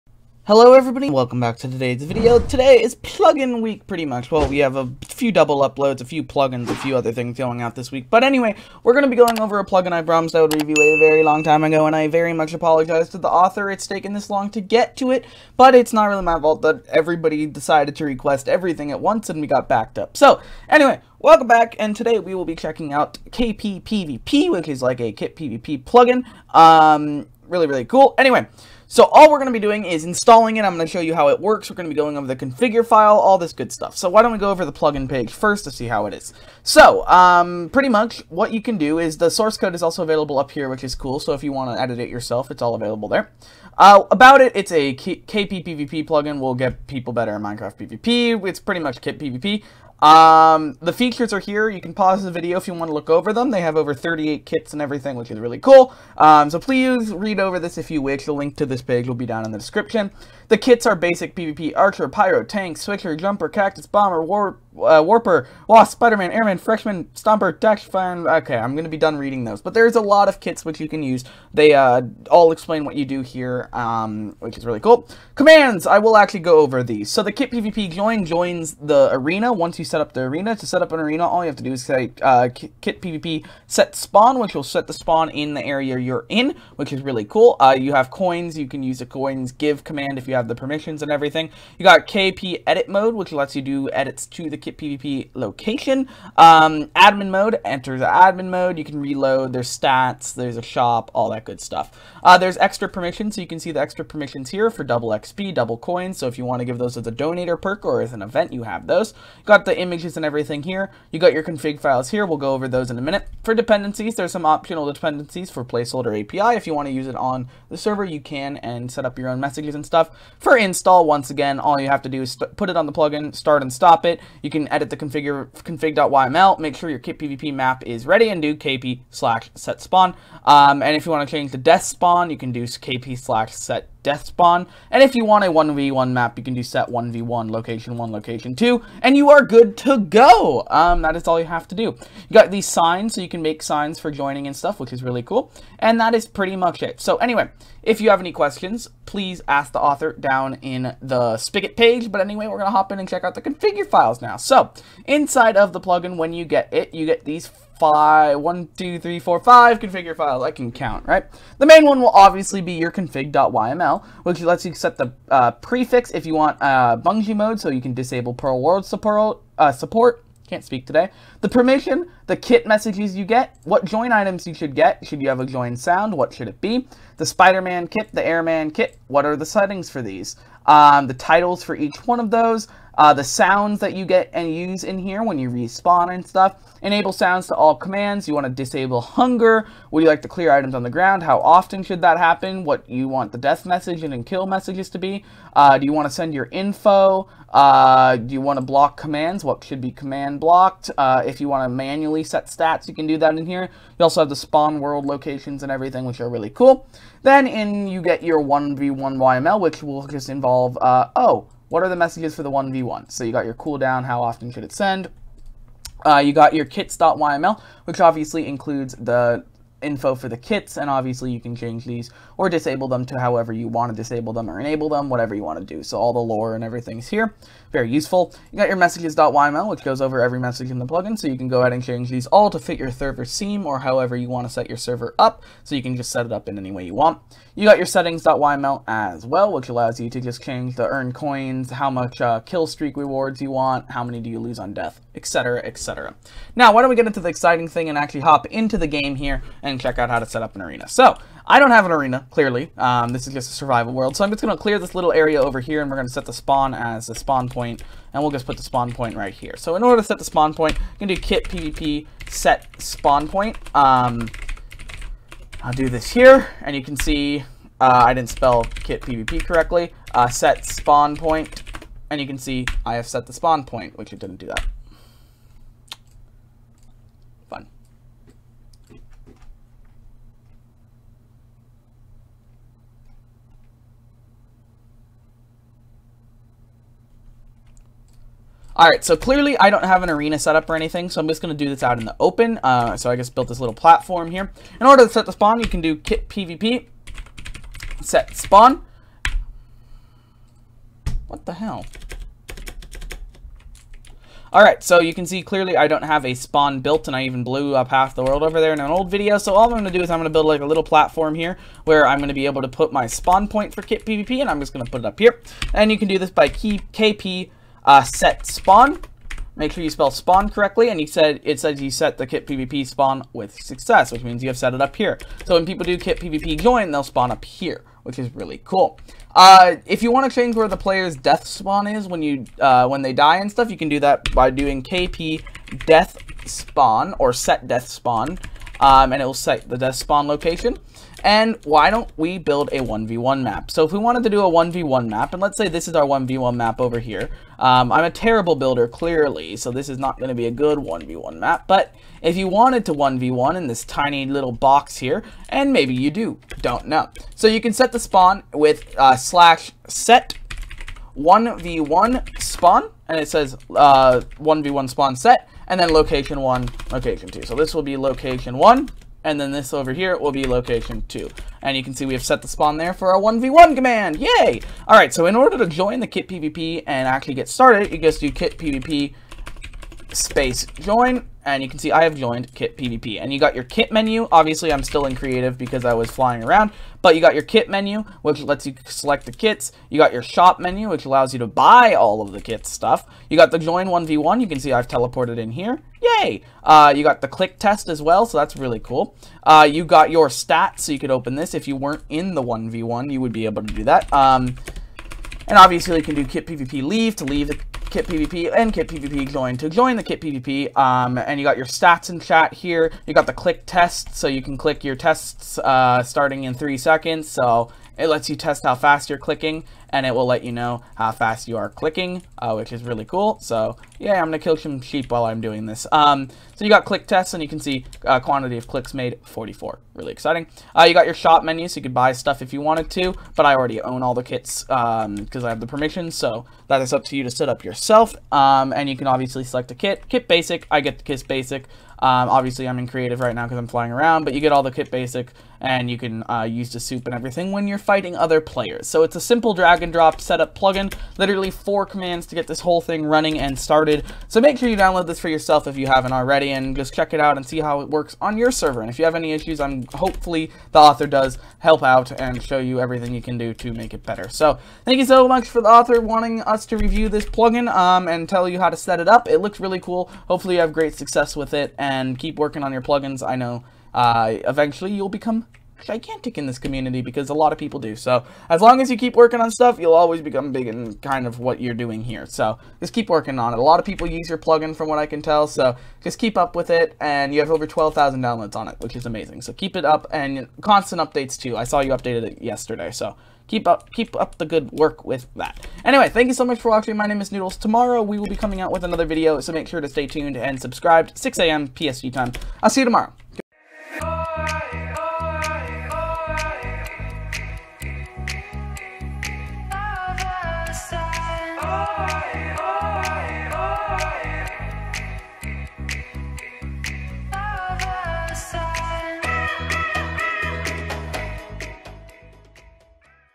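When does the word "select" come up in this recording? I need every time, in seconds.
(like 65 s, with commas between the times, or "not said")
388 s, 439 s.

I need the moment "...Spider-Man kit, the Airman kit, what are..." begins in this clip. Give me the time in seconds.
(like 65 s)
177 s.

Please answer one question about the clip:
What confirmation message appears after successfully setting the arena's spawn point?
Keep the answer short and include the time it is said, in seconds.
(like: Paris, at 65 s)
You set the kit PvP spawn with success, at 321 s.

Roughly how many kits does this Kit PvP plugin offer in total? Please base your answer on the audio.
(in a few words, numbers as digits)
over 38.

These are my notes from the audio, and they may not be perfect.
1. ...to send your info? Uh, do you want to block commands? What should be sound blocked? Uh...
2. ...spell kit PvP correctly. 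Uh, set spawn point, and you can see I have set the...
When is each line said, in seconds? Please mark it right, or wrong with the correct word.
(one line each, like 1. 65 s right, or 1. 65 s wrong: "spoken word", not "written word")
1. 196 s wrong: "command", not "sound"
2. 268 s right.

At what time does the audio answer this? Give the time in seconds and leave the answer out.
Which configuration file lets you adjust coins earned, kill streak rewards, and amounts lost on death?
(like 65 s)
237 s.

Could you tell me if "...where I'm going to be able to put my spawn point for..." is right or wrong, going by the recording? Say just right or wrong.
right.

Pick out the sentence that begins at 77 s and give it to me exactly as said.
So the kit PvP join joins the arena.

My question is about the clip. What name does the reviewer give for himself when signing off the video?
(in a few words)
Noodles.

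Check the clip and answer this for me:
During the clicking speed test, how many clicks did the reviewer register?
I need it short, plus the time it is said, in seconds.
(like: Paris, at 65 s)
44, at 429 s.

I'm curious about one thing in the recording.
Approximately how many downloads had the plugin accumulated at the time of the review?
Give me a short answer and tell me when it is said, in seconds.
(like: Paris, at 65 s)
over 12,000, at 487 s.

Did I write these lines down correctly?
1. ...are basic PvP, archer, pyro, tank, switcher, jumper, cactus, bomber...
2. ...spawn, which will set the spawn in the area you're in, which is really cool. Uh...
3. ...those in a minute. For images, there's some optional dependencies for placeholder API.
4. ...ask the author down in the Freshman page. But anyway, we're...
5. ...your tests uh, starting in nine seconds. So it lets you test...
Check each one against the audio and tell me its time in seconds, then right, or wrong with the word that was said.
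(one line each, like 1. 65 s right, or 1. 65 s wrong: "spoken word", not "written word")
1. 60 s right
2. 83 s right
3. 112 s wrong: "dependencies", not "images"
4. 149 s wrong: "Spigot", not "Freshman"
5. 414 s wrong: "three", not "nine".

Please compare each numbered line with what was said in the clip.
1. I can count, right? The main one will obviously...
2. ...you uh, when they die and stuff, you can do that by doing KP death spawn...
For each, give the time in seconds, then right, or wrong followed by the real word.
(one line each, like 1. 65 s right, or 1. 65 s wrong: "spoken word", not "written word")
1. 160 s right
2. 332 s right.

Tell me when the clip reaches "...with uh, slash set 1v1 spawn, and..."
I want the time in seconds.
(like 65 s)
358 s.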